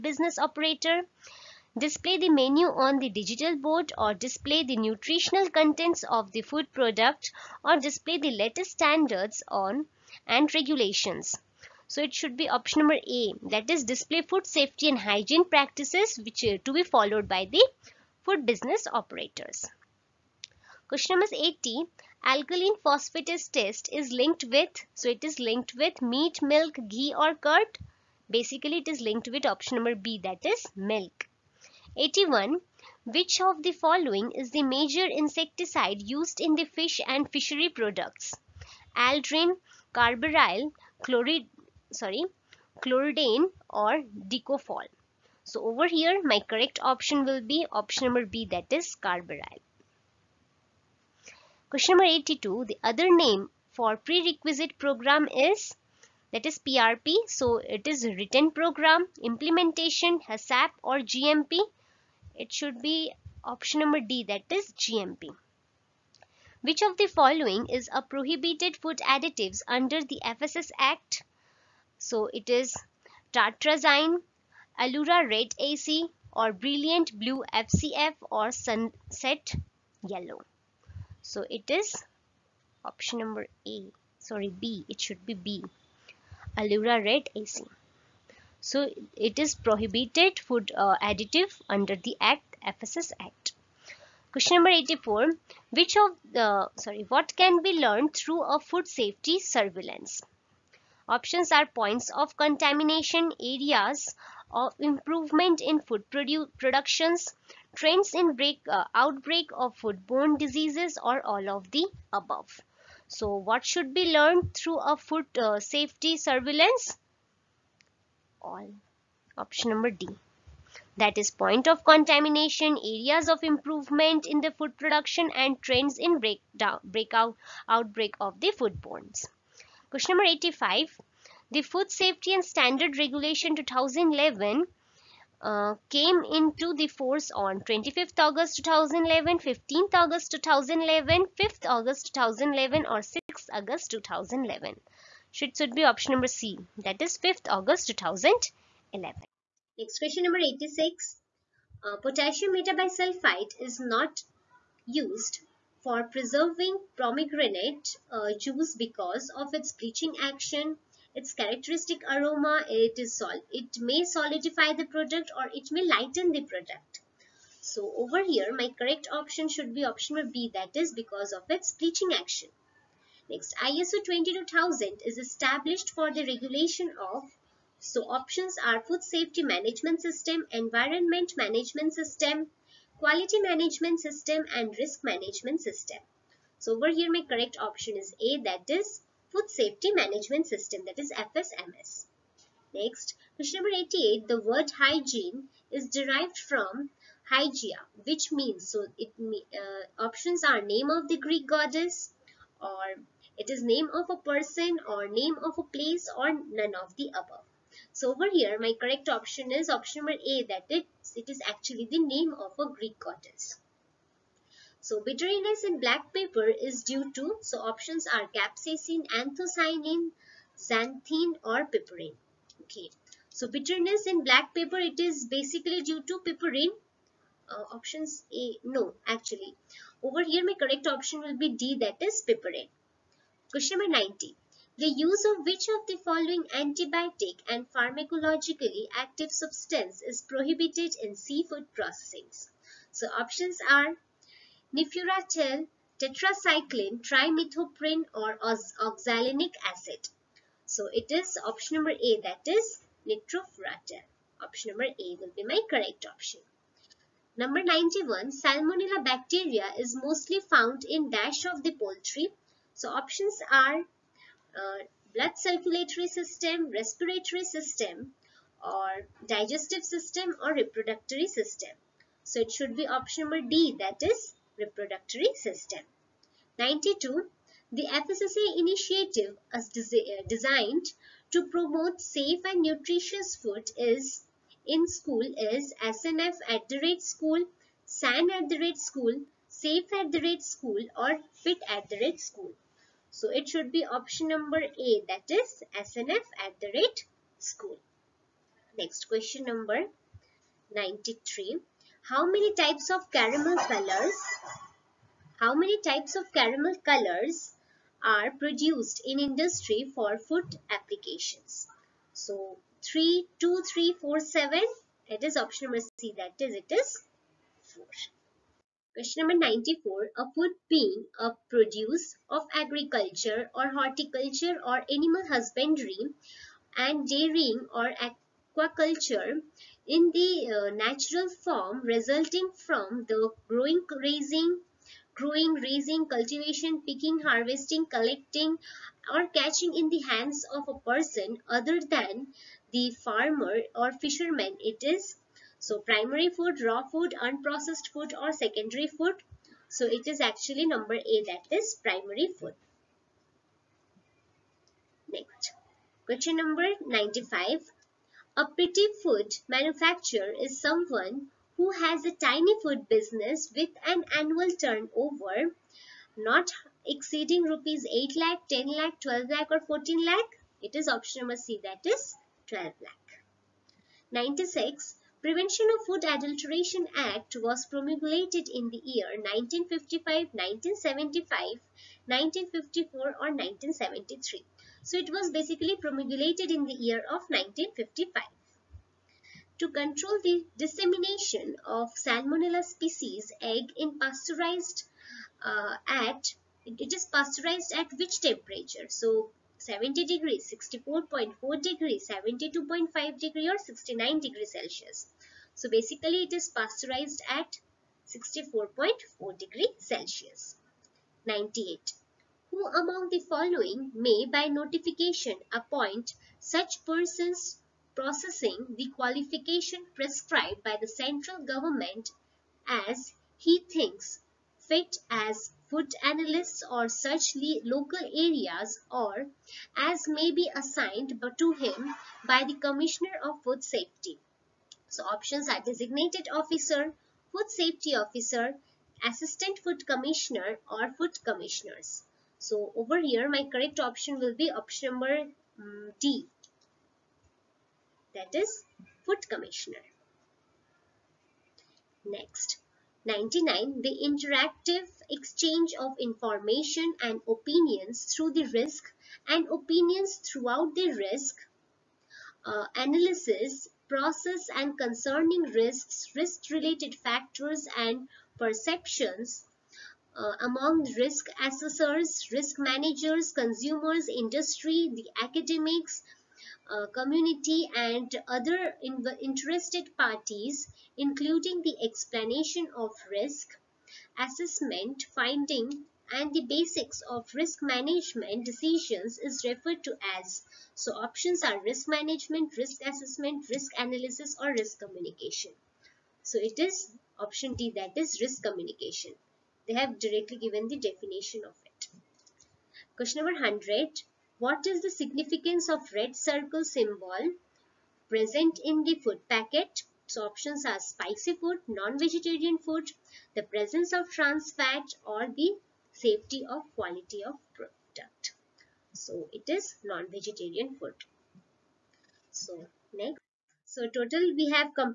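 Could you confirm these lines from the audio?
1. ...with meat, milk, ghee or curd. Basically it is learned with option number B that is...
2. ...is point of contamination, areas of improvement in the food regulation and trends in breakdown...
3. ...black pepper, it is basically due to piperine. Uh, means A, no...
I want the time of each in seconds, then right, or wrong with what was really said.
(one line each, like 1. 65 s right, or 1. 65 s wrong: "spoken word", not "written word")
1. 25 s wrong: "linked", not "learned"
2. 121 s wrong: "production", not "regulation"
3. 224 s wrong: "options", not "means".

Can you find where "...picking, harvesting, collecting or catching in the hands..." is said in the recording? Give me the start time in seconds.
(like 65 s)
336 s.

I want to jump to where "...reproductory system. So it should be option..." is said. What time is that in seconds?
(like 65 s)
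270 s.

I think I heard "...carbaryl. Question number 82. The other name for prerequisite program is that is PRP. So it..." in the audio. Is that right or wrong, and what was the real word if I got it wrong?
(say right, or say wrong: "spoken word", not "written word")
right.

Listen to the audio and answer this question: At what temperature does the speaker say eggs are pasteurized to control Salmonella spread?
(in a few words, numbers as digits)
64.4 degrees Celsius.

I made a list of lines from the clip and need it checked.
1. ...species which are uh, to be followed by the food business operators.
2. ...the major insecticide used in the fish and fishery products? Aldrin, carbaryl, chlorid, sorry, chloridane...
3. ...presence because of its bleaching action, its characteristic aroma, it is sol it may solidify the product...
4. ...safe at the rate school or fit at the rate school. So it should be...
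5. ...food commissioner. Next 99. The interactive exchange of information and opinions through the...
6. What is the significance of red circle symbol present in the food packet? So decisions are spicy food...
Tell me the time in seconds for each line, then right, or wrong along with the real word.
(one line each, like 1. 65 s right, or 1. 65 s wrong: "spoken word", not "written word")
1. 15 s wrong: "practices", not "species"
2. 34 s right
3. 158 s wrong: "juice", not "presence"
4. 289 s right
5. 449 s right
6. 504 s wrong: "options", not "decisions".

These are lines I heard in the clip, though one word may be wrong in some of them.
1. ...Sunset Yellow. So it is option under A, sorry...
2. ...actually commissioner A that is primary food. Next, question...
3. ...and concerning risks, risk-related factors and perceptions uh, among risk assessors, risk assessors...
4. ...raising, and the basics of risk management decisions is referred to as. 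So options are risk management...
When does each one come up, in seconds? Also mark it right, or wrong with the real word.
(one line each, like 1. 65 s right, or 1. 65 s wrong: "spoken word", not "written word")
1. 78 s wrong: "number", not "under"
2. 350 s wrong: "number", not "commissioner"
3. 464 s wrong: "managers", not "assessors"
4. 485 s wrong: "finding", not "raising".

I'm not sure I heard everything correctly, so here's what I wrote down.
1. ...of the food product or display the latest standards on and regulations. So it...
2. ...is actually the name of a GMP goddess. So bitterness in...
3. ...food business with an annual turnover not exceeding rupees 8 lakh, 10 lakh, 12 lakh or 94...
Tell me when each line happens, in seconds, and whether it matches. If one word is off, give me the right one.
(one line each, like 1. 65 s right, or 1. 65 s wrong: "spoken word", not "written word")
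1. 6 s right
2. 211 s wrong: "Greek", not "GMP"
3. 362 s wrong: "14", not "94".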